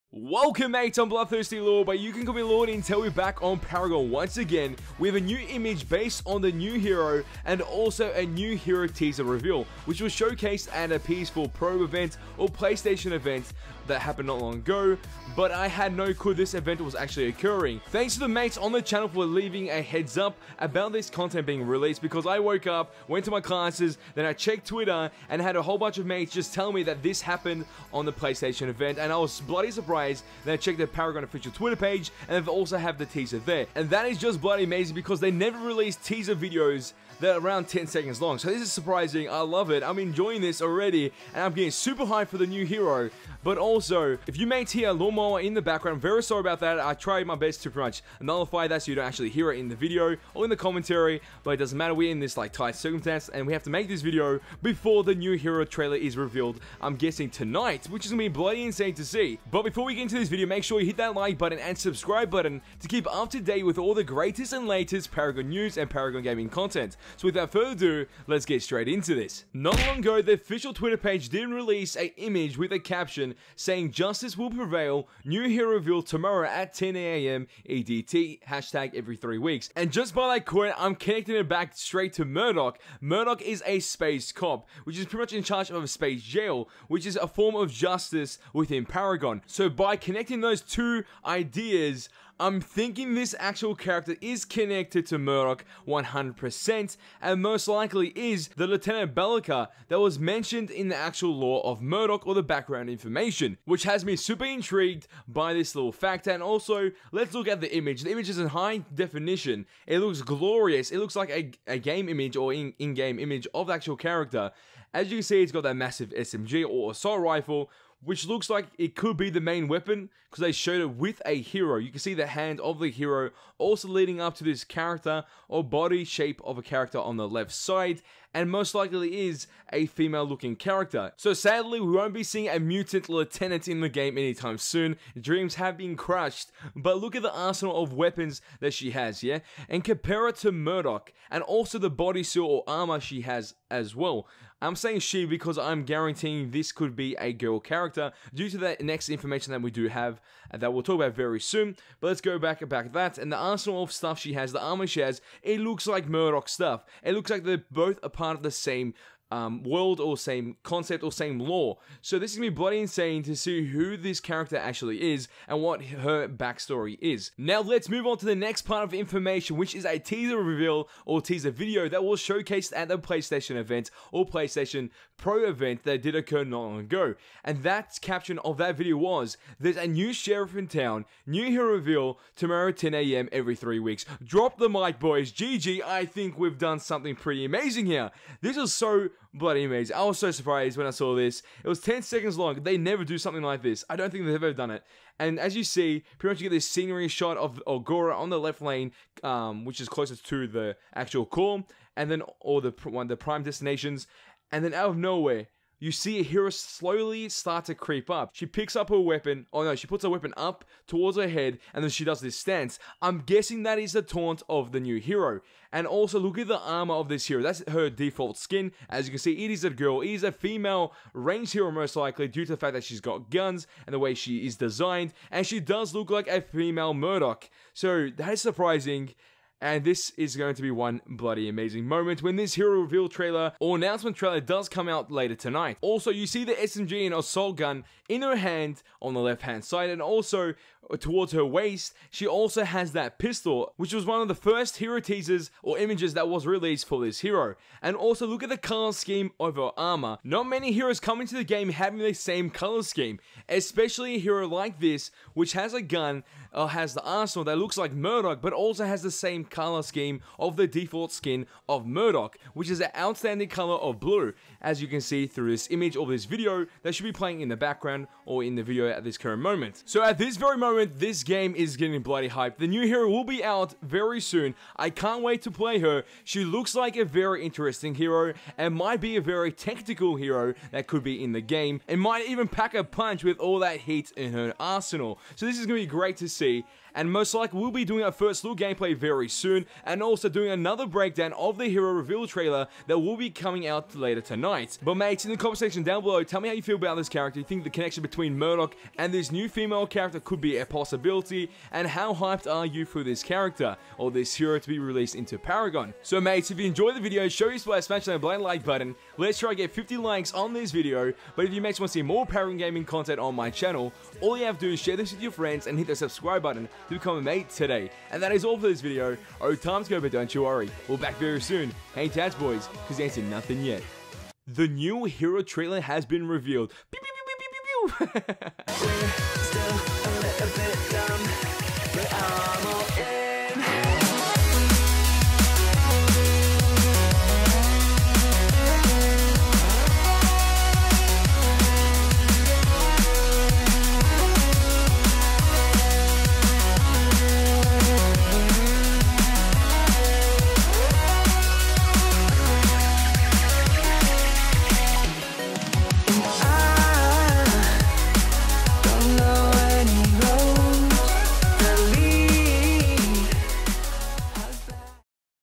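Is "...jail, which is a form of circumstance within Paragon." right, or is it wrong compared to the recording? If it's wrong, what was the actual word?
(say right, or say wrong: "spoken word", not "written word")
wrong: "justice", not "circumstance".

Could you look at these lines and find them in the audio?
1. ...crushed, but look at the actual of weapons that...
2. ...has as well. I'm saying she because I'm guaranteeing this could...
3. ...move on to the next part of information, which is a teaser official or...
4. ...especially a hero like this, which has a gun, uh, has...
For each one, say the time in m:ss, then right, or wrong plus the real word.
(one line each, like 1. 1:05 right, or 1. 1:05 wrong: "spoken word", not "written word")
1. 2:15 wrong: "arsenal", not "actual"
2. 2:23 right
3. 2:47 wrong: "reveal", not "official"
4. 4:13 right.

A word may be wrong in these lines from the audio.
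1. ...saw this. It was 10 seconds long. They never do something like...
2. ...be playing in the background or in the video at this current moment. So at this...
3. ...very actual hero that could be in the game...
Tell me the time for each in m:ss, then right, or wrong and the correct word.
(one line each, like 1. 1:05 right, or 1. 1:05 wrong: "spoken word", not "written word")
1. 3:10 right
2. 4:27 right
3. 4:39 wrong: "tactical", not "actual".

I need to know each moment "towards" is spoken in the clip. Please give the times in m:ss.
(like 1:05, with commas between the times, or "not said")
3:30, 4:00.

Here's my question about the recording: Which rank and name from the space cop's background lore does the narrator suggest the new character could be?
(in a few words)
Lieutenant Belica.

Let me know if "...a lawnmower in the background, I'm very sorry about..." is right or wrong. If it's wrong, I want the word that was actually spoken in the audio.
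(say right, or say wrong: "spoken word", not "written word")
right.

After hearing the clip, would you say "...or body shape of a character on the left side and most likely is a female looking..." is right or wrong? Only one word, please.
right.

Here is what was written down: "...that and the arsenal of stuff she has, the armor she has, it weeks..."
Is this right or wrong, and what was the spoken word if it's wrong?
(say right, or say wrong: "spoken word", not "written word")
wrong: "looks", not "weeks".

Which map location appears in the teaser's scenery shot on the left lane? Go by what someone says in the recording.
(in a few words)
Agora.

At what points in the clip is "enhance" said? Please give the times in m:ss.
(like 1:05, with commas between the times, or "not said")
not said.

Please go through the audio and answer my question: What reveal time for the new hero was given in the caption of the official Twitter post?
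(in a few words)
10am EDT.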